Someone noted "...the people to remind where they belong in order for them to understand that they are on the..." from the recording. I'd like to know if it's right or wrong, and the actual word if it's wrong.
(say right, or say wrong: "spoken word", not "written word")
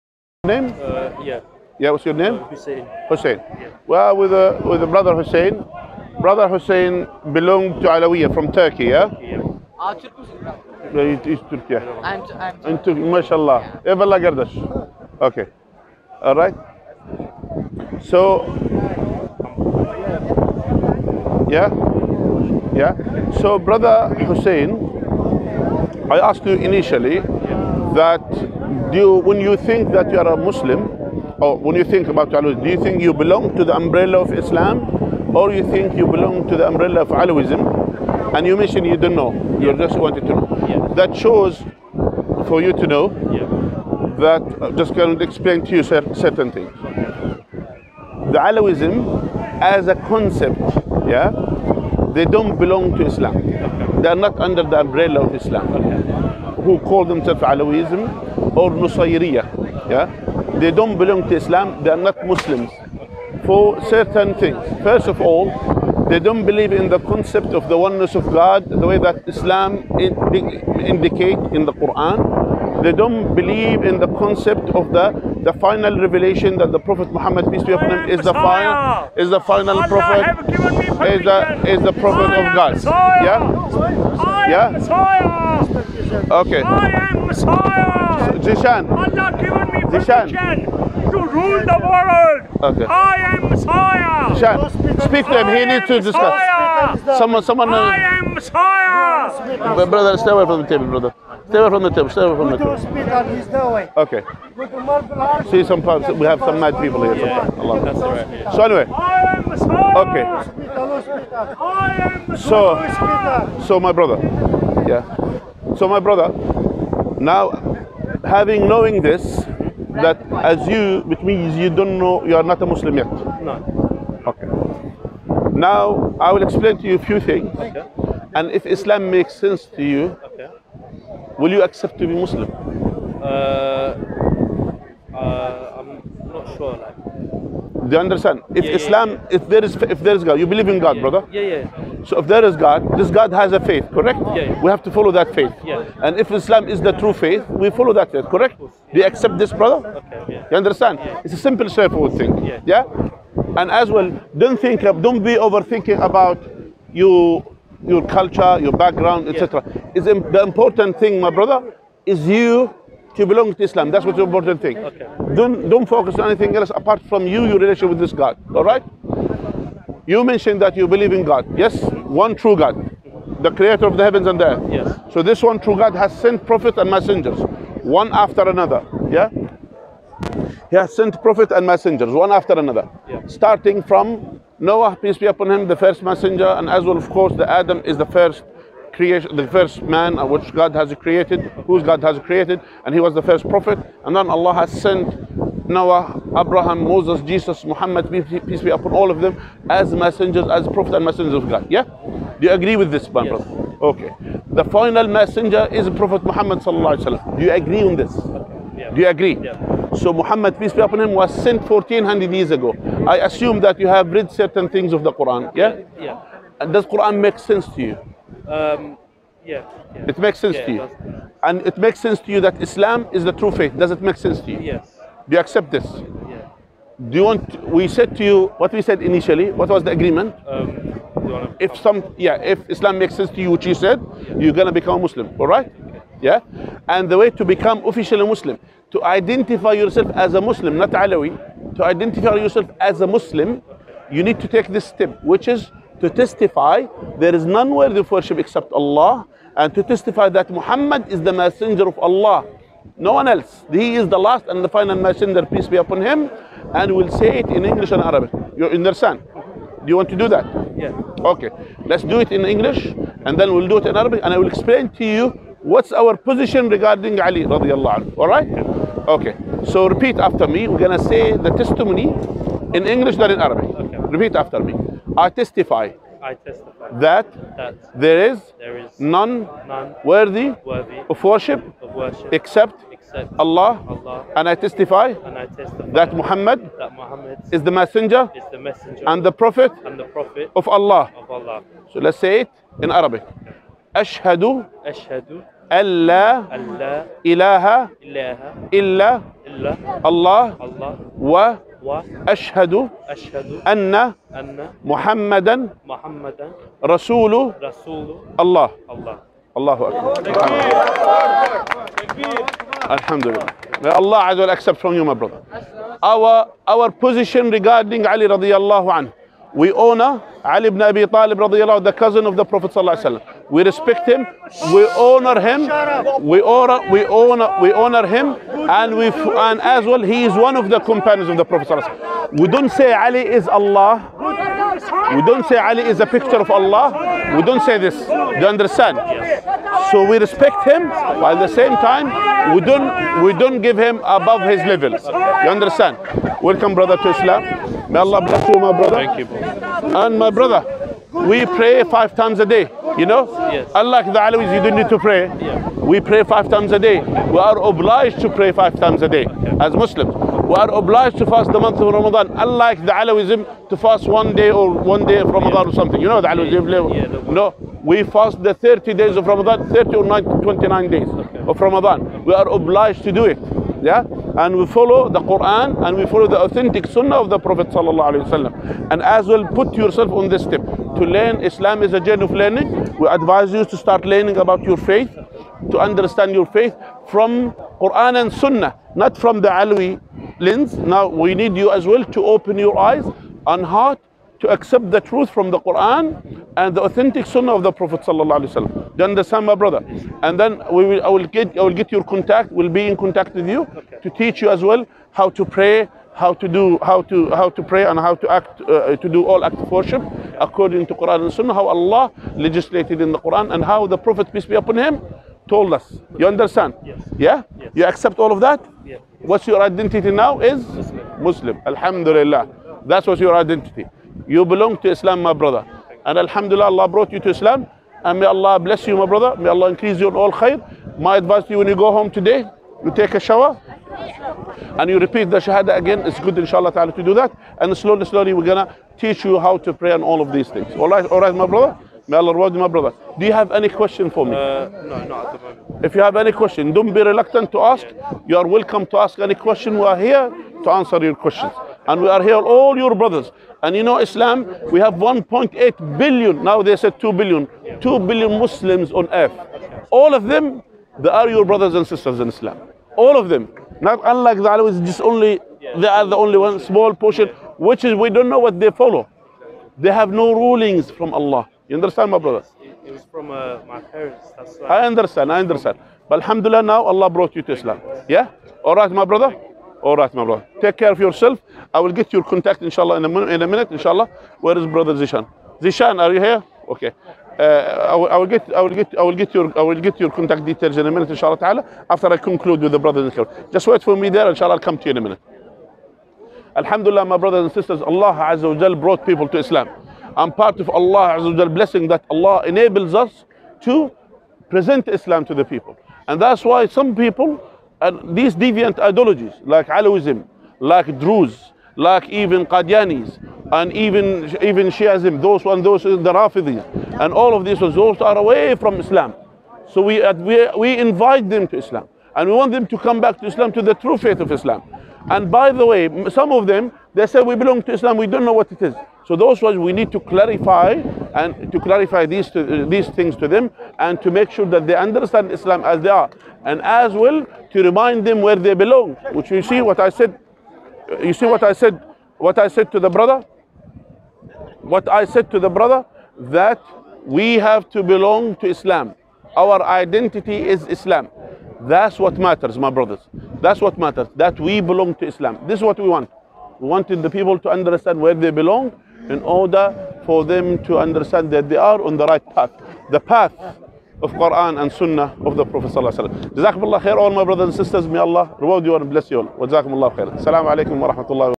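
wrong: "understand", not "remind".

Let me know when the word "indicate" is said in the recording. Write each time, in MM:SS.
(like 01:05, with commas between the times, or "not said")
01:10.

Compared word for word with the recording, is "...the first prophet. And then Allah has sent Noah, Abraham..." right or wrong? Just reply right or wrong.
right.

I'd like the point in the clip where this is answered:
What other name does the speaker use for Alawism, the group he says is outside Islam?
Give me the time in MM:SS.
00:58.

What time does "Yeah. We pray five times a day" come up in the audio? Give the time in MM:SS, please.
05:55.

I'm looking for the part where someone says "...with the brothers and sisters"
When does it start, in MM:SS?
08:12.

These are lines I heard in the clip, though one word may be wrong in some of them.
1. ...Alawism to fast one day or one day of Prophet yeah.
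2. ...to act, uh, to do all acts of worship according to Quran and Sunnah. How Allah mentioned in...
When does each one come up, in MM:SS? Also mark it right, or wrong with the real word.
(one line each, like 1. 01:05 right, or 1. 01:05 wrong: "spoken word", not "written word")
1. 06:02 wrong: "Ramadan", not "Prophet"
2. 06:48 wrong: "legislated", not "mentioned".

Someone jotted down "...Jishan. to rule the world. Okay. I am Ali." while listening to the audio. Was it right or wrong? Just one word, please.
wrong.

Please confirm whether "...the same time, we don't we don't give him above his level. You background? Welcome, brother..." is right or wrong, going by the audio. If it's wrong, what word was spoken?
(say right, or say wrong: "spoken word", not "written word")
wrong: "understand", not "background".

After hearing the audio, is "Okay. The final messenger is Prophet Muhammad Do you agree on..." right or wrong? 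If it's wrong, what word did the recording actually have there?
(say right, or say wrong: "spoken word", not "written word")
right.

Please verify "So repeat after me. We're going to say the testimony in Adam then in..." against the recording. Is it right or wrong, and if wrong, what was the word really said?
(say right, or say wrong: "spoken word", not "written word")
wrong: "English", not "Adam".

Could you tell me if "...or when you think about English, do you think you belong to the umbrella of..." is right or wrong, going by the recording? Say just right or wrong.
wrong.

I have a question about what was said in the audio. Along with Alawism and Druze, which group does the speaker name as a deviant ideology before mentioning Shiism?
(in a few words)
Qadianis.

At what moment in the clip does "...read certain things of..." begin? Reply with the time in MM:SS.
03:34.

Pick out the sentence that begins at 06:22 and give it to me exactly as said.
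We advise you to start learning about your faith, to understand your faith from Quran and Sunnah, not from the Alawi lens.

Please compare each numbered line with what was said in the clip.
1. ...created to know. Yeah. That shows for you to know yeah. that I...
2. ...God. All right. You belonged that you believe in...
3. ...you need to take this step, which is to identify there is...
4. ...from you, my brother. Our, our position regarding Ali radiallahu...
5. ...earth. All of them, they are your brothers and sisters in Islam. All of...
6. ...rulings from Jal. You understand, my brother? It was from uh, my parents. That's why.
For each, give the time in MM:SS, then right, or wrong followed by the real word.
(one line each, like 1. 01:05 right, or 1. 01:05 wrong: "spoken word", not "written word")
1. 00:39 wrong: "wanted", not "created"
2. 02:48 wrong: "mentioned", not "belonged"
3. 04:04 wrong: "testify", not "identify"
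4. 05:14 right
5. 07:39 right
6. 07:50 wrong: "Allah", not "Jal".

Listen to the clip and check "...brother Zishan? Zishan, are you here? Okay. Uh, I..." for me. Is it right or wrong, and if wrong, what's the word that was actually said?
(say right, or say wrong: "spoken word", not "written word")
right.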